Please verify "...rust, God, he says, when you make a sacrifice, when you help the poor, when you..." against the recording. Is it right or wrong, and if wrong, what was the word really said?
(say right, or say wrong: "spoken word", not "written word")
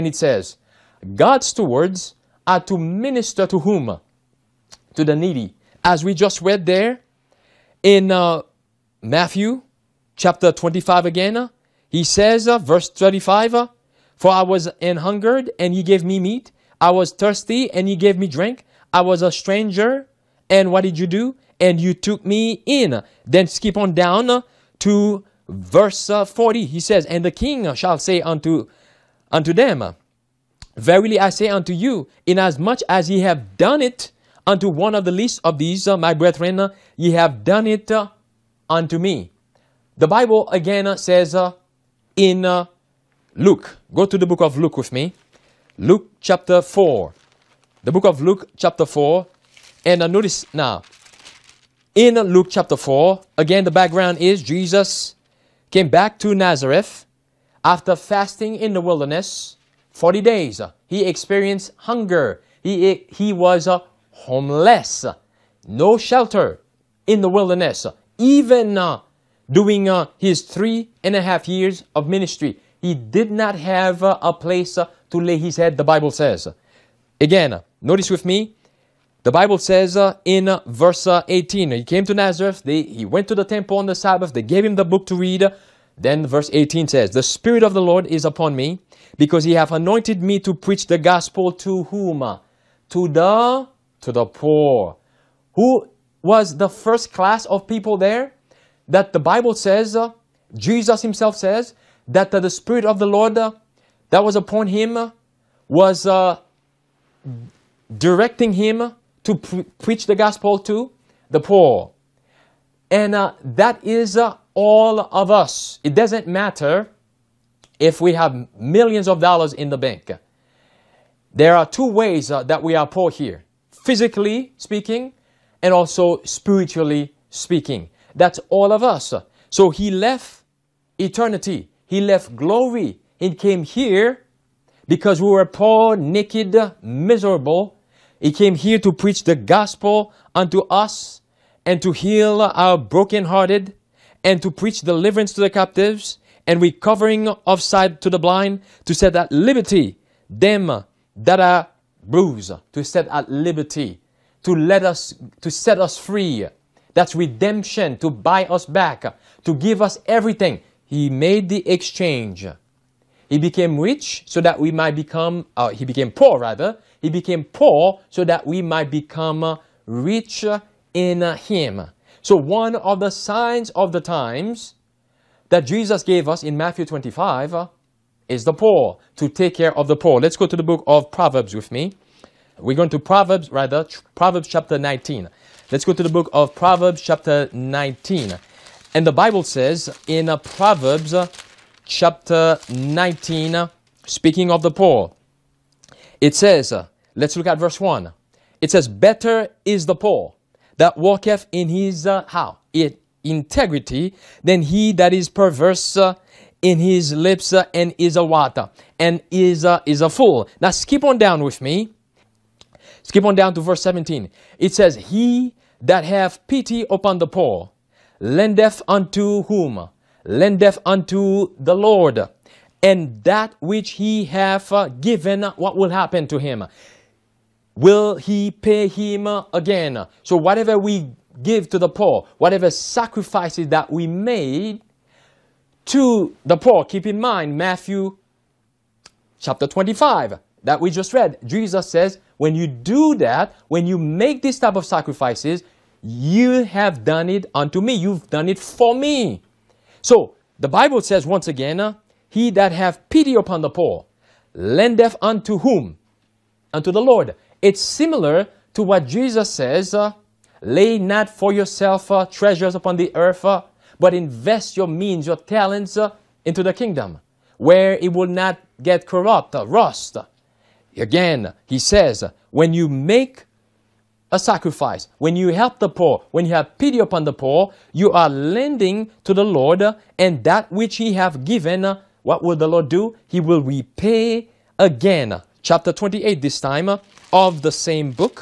wrong: "Again", not "God".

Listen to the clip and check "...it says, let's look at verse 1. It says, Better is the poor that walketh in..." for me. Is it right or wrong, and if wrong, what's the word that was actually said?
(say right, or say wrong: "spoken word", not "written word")
right.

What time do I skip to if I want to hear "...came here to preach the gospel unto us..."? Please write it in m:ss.
2:18.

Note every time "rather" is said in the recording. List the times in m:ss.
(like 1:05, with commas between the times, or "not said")
2:46, 3:03.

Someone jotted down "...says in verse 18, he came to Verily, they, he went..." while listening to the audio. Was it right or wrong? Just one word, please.
wrong.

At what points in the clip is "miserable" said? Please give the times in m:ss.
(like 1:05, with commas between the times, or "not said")
2:16.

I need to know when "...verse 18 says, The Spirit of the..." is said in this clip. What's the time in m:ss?
1:26.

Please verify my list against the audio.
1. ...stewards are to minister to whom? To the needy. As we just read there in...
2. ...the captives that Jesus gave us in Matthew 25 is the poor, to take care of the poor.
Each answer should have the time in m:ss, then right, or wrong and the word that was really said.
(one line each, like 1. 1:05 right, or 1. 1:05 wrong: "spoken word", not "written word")
1. 0:01 right
2. 2:53 wrong: "times", not "captives".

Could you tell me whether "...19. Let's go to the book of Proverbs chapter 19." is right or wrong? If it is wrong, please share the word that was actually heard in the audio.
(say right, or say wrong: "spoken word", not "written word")
right.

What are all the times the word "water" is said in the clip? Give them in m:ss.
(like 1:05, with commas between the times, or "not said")
3:28.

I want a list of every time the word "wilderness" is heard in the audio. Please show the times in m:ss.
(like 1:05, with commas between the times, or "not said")
0:58, 1:07.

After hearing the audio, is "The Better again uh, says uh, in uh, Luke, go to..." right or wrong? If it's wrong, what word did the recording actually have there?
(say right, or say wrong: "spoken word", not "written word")
wrong: "Bible", not "Better".